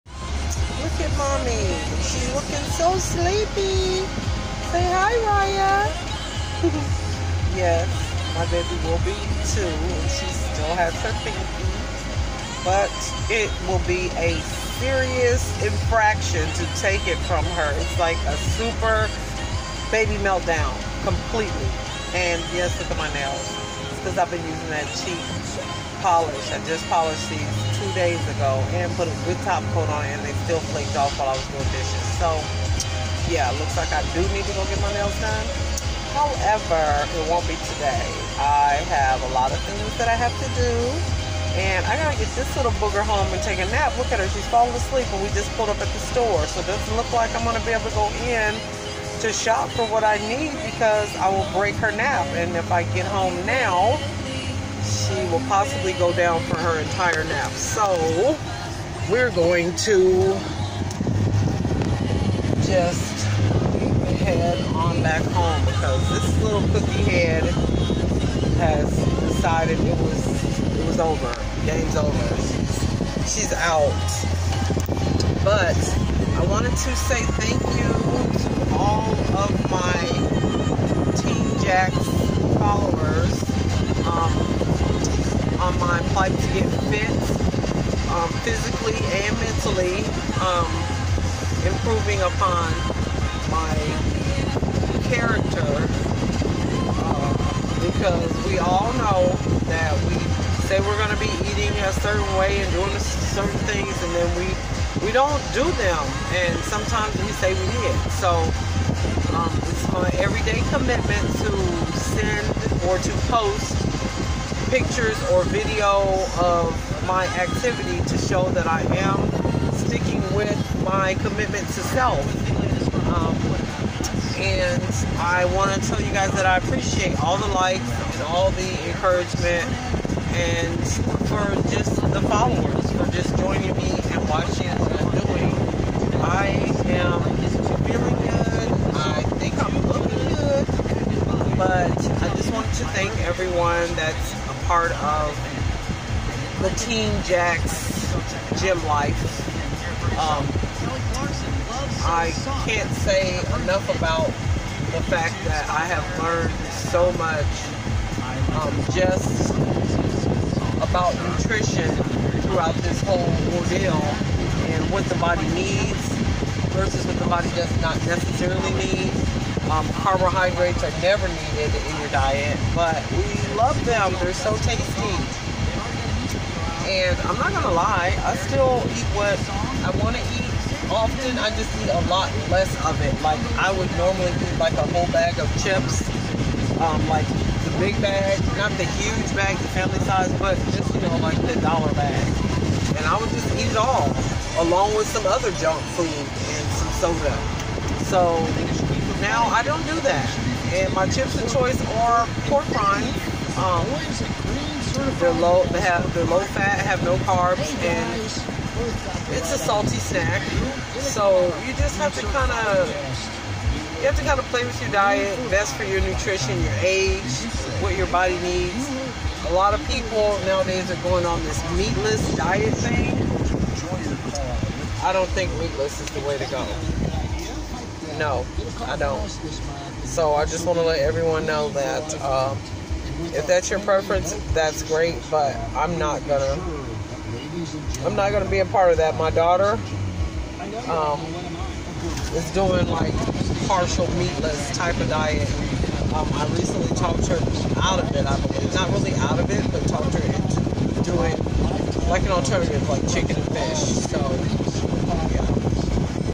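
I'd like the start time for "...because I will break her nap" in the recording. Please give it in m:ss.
0:50.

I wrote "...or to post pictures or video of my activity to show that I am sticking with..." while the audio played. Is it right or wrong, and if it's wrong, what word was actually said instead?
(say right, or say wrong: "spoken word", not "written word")
right.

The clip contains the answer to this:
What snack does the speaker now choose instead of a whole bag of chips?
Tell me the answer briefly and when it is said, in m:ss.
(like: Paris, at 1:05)
pork rinds, at 3:22.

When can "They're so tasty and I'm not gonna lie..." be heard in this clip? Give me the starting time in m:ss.
2:54.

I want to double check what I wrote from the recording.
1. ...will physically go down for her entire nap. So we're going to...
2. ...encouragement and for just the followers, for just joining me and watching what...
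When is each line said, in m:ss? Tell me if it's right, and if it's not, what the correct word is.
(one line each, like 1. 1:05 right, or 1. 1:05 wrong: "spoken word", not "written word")
1. 0:55 wrong: "possibly", not "physically"
2. 2:08 right.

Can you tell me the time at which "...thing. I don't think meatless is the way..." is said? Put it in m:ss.
3:42.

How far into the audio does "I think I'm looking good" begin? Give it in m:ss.
2:18.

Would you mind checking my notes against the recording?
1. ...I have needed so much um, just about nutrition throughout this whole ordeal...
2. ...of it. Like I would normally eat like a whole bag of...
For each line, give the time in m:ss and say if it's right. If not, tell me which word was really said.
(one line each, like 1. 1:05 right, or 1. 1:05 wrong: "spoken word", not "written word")
1. 2:35 wrong: "learned", not "needed"
2. 3:02 right.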